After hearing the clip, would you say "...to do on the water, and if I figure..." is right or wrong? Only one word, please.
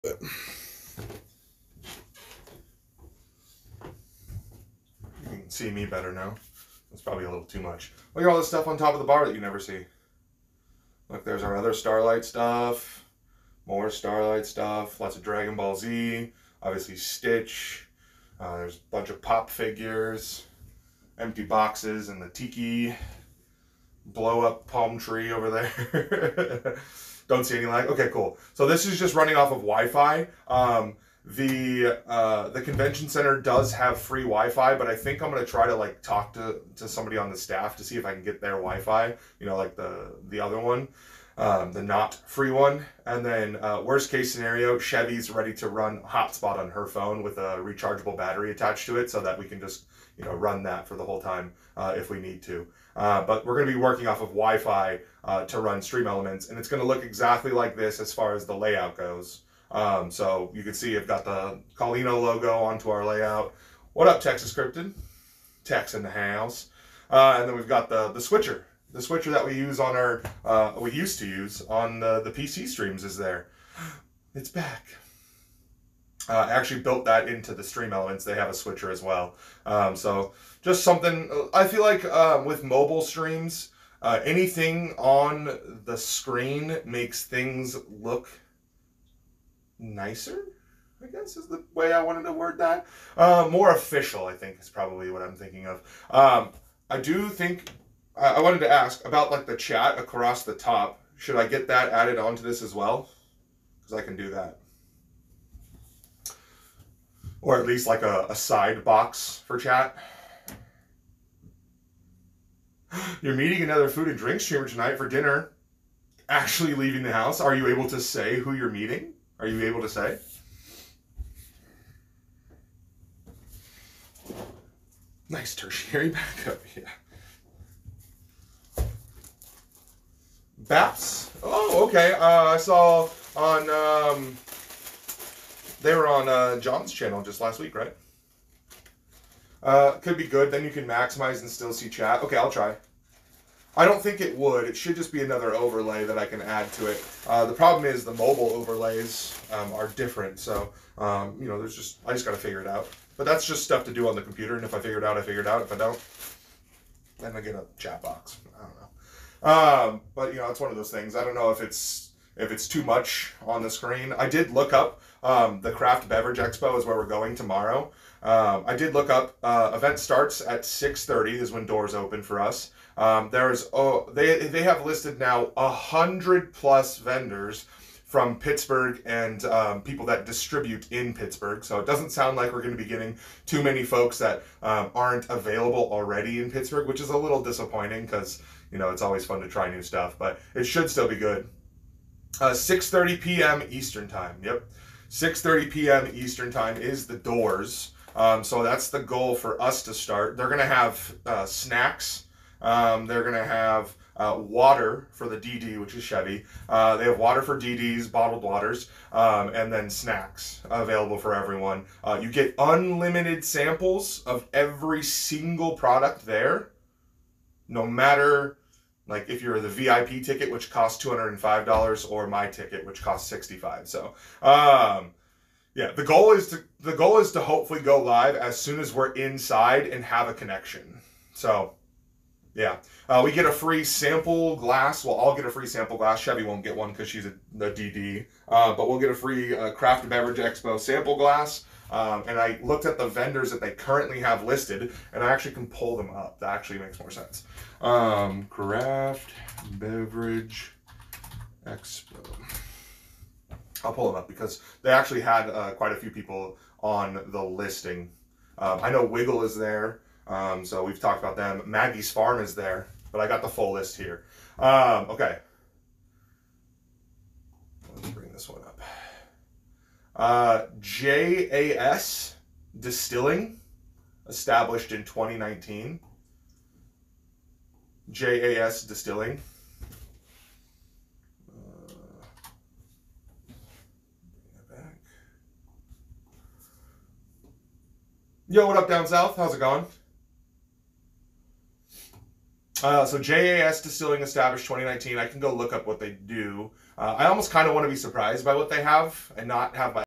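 wrong.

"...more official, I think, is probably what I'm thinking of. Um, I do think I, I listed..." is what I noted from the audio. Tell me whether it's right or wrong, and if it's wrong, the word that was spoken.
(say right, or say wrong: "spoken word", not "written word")
wrong: "wanted", not "listed".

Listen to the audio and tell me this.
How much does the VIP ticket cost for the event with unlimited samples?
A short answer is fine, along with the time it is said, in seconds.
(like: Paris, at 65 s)
$205, at 221 s.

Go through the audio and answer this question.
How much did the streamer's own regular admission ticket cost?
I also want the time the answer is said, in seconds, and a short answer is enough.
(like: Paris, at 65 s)
$65, at 223 s.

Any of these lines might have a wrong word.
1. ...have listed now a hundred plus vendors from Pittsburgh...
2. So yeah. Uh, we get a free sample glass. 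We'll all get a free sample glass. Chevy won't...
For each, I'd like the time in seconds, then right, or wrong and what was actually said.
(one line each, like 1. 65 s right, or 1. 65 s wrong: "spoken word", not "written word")
1. 174 s right
2. 231 s right.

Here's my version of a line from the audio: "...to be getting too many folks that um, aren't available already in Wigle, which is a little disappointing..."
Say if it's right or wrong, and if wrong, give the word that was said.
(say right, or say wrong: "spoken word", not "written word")
wrong: "Pittsburgh", not "Wigle".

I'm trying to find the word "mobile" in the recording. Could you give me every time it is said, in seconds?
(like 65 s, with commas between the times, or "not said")
82 s, 148 s.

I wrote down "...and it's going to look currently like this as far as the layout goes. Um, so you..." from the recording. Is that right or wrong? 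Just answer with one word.
wrong.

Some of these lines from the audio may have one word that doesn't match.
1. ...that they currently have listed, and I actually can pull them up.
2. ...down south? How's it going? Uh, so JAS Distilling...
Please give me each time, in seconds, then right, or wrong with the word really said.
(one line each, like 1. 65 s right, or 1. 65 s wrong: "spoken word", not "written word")
1. 243 s right
2. 288 s right.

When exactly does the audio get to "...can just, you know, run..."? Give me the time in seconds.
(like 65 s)
49 s.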